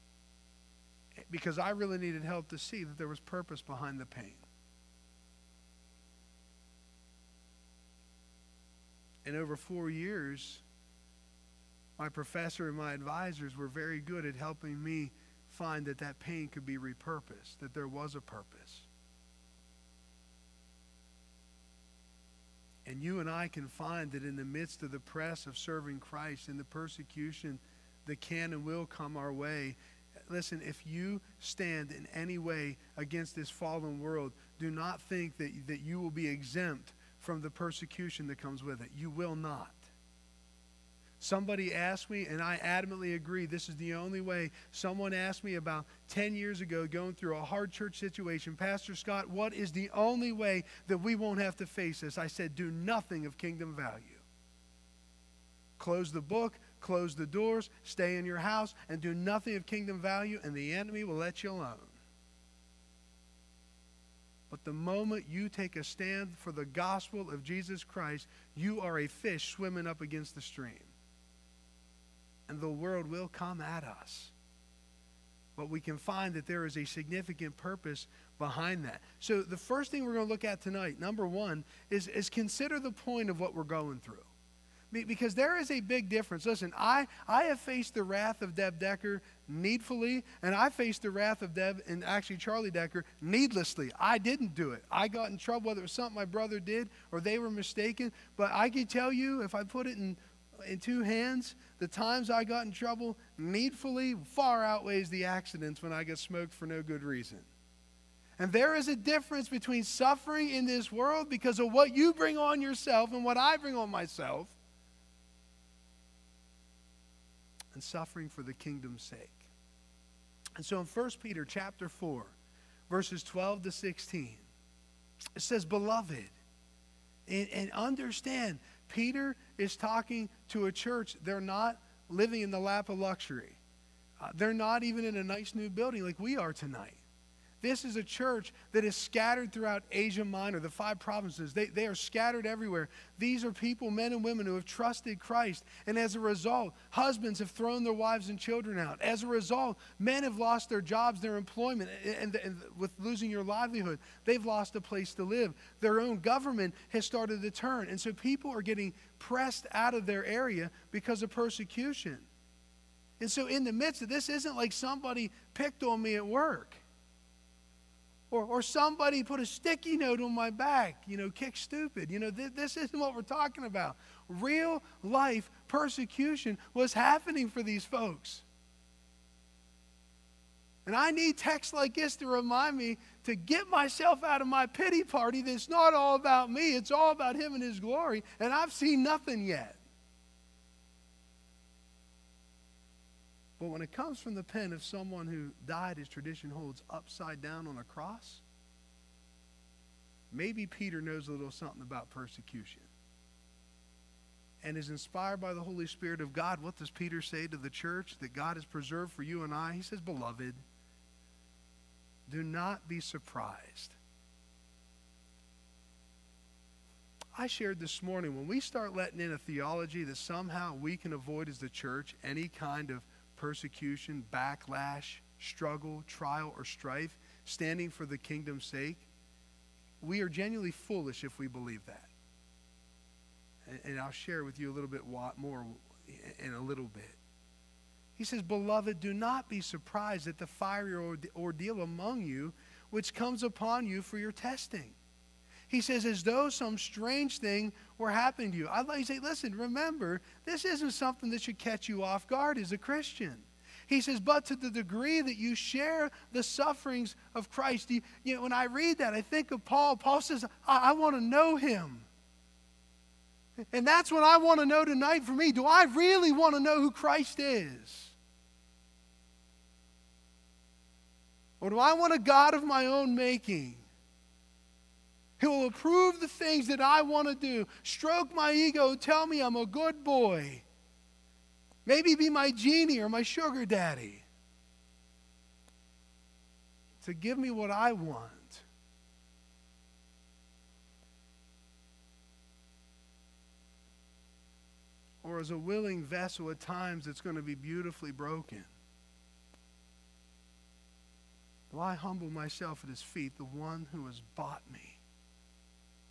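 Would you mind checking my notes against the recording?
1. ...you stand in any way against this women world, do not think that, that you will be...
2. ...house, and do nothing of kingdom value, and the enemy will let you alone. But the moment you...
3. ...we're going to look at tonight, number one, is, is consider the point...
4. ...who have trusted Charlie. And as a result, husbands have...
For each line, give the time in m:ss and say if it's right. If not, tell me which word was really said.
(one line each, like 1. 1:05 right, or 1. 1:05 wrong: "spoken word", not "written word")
1. 0:30 wrong: "fallen", not "women"
2. 0:58 right
3. 1:20 right
4. 2:24 wrong: "Christ", not "Charlie".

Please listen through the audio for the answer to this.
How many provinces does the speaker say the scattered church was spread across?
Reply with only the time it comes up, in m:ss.
2:20.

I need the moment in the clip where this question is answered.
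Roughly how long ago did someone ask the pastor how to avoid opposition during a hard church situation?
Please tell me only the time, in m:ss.
0:46.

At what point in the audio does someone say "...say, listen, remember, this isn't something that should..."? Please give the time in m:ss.
4:09.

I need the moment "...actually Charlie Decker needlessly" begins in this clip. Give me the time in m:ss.
1:32.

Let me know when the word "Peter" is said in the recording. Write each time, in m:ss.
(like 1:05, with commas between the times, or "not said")
2:01, 2:08, 3:20, 3:26.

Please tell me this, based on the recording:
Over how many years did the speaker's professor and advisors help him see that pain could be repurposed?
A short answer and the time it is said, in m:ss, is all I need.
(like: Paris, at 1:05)
4, at 0:09.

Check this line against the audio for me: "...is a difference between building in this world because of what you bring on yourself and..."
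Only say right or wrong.
wrong.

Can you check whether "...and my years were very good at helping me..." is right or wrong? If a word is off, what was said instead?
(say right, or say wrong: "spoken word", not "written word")
wrong: "advisors", not "years".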